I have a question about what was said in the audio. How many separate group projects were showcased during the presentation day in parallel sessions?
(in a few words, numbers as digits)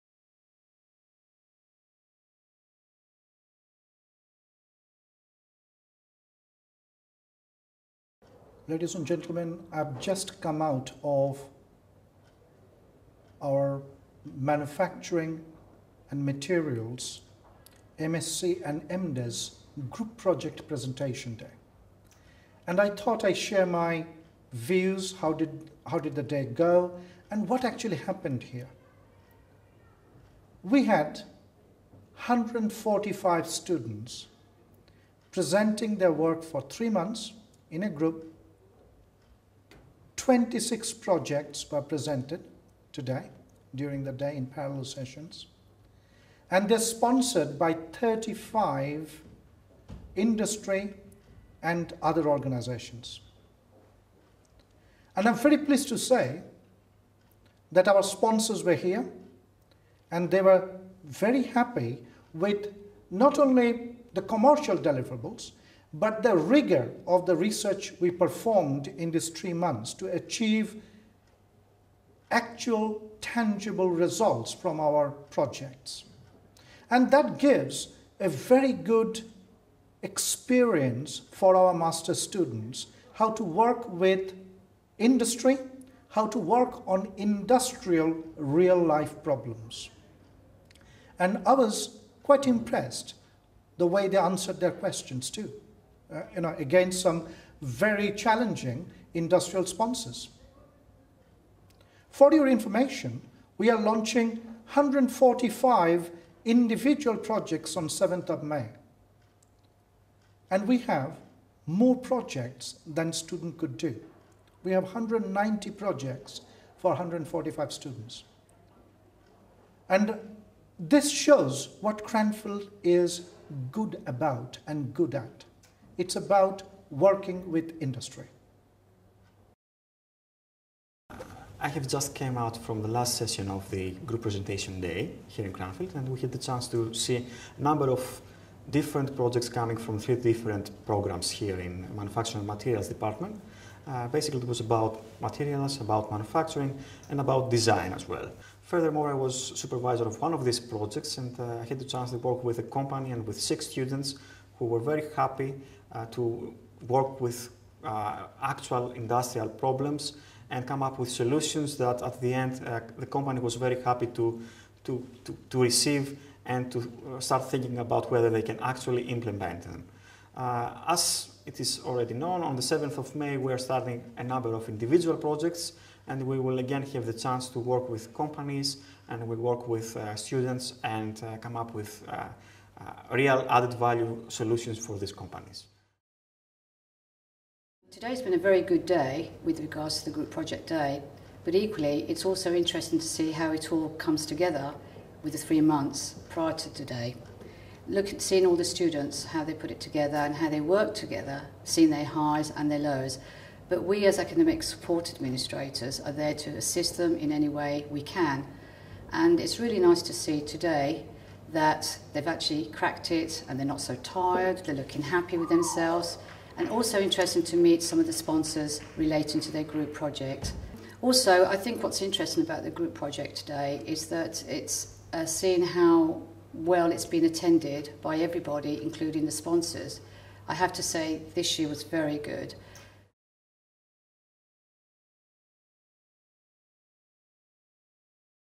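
26.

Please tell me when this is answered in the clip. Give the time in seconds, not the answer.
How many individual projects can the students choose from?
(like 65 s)
114 s.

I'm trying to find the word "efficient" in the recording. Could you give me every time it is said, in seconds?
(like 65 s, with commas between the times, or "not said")
not said.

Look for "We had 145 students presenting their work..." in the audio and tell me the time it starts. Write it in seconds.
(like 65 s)
30 s.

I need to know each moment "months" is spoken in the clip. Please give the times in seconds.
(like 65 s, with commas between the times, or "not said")
36 s, 69 s, 195 s.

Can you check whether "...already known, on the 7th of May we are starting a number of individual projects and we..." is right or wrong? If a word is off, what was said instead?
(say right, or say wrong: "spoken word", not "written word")
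right.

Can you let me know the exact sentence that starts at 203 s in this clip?
But we as academic support administrators are there to assist them in any way we can.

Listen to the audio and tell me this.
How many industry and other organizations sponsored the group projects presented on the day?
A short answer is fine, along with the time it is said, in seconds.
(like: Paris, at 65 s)
35, at 47 s.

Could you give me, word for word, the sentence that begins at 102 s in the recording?
For your information, we are launching 145 individual projects on 7th of May.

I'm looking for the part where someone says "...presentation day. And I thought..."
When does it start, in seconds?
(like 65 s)
20 s.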